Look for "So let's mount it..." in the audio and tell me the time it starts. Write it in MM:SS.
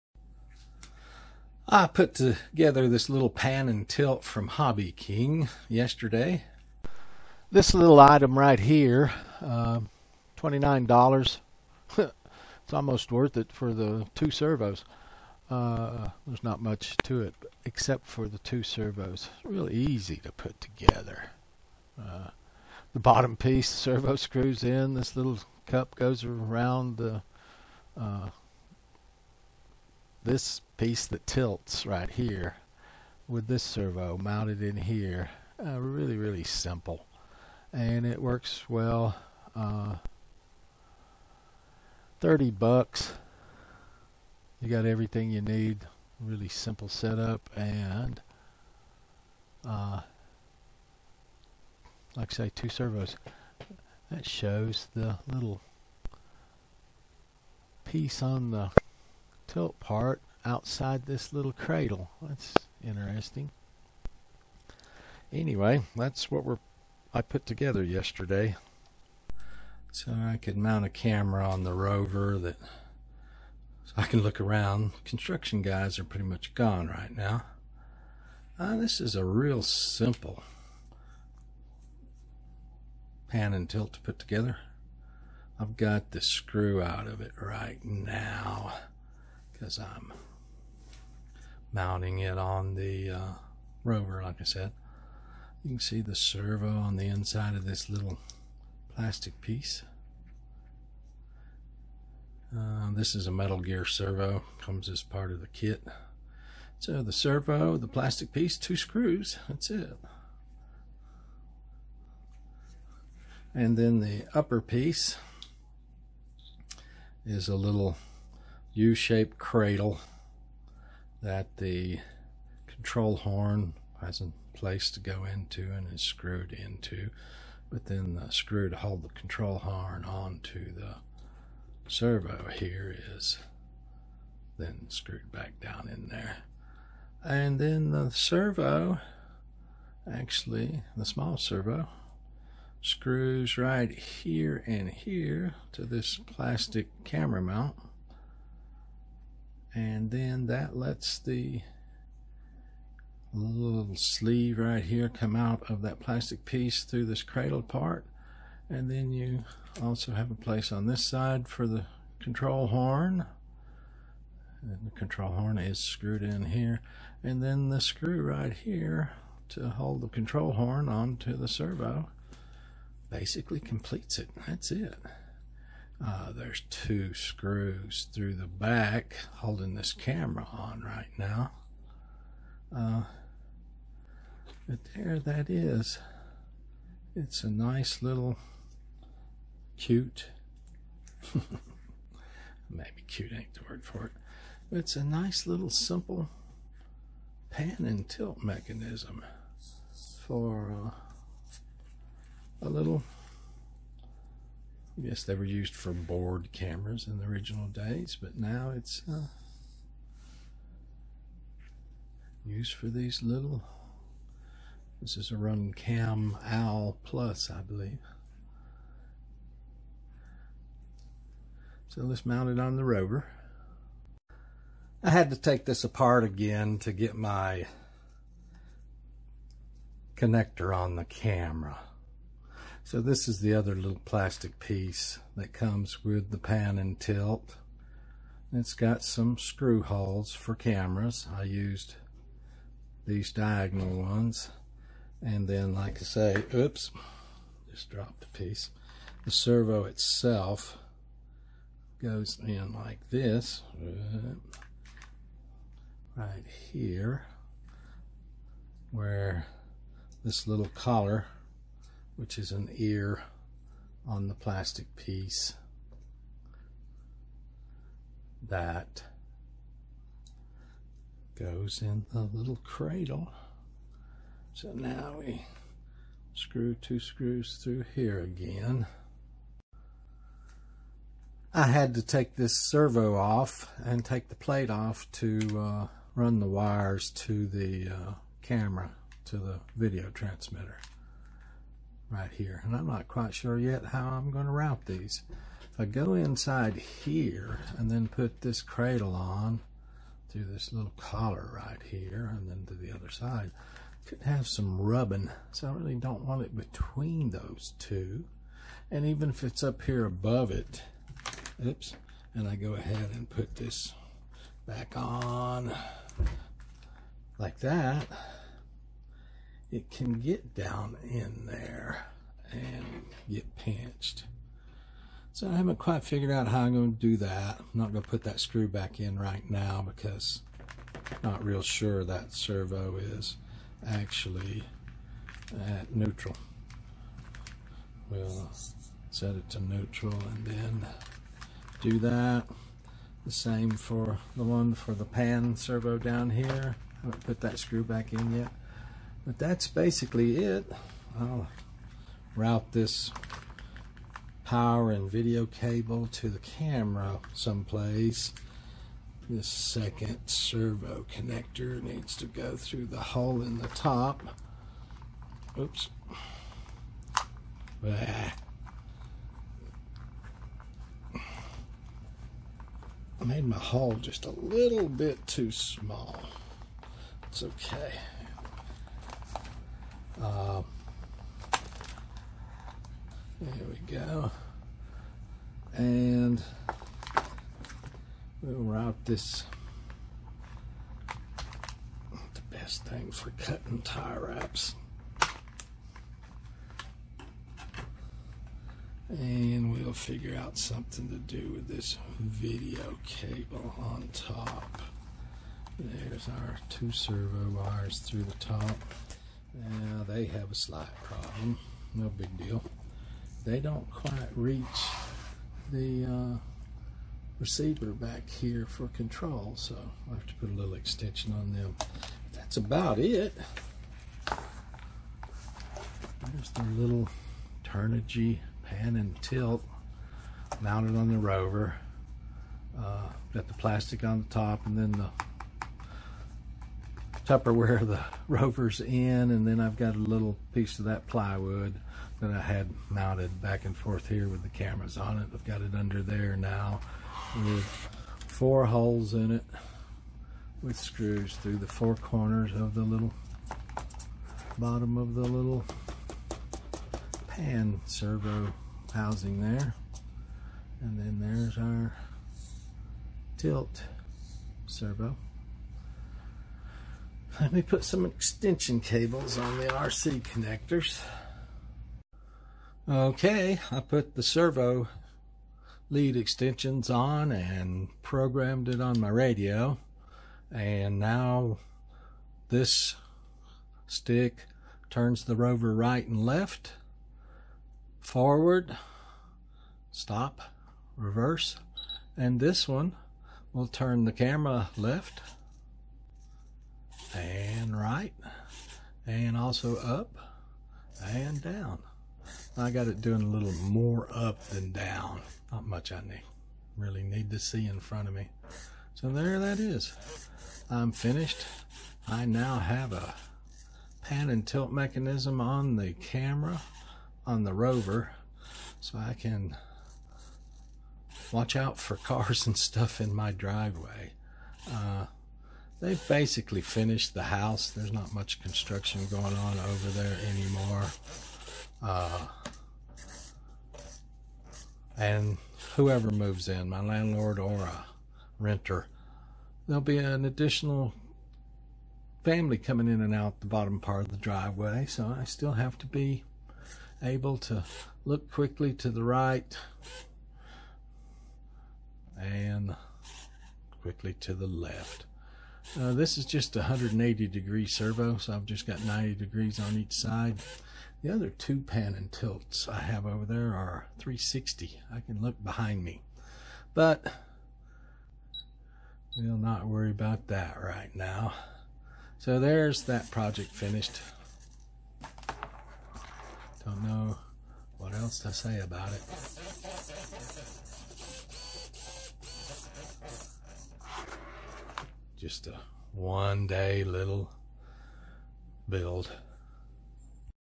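03:41.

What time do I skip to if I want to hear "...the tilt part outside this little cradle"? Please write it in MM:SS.
00:58.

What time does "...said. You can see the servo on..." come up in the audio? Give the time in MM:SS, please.
01:34.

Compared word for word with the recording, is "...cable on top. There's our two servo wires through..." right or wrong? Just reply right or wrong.
right.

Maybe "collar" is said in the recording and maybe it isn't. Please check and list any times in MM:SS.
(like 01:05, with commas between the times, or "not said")
04:20, 05:00.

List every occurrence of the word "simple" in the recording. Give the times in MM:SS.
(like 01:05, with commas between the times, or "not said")
00:36, 00:46, 01:19, 03:15.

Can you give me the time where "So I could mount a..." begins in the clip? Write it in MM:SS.
01:09.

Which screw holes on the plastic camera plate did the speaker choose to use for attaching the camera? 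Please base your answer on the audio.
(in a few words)
diagonal ones.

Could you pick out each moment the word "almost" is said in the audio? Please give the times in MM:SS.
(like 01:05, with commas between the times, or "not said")
00:12.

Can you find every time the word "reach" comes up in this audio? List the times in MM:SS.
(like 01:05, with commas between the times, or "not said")
06:54.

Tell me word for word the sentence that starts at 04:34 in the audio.
So now we screw two screws through here again.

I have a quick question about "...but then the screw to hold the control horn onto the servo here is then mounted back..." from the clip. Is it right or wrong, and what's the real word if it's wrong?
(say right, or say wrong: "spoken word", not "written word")
wrong: "screwed", not "mounted".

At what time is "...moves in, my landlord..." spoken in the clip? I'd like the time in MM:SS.
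08:56.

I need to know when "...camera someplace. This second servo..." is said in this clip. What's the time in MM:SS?
05:56.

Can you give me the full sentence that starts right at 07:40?
And then there's our tilt servo.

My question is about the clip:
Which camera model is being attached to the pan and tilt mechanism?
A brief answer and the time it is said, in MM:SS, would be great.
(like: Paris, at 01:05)
RunCam Owl Plus, at 03:35.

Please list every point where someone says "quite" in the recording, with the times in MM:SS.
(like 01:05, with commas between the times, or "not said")
04:53, 05:25, 06:53.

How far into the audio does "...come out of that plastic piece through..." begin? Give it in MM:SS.
02:35.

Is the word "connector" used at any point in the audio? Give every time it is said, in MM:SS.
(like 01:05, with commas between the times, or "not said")
03:50, 06:01, 07:50.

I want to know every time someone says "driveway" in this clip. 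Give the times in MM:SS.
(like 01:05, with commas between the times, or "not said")
08:43, 09:04.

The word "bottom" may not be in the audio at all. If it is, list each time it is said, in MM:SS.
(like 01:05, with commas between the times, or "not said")
00:22, 07:34, 09:03.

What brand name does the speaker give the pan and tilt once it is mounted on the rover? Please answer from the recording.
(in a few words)
Turnigy.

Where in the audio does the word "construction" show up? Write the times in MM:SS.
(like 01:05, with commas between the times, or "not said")
01:15, 08:48.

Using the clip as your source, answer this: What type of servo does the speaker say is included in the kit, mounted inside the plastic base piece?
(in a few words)
Metal Gear servo.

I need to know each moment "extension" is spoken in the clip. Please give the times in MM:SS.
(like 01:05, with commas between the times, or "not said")
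07:00, 07:48, 07:56.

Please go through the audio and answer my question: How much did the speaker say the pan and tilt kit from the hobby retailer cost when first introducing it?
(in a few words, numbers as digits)
$29.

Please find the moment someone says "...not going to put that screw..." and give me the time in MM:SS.
05:27.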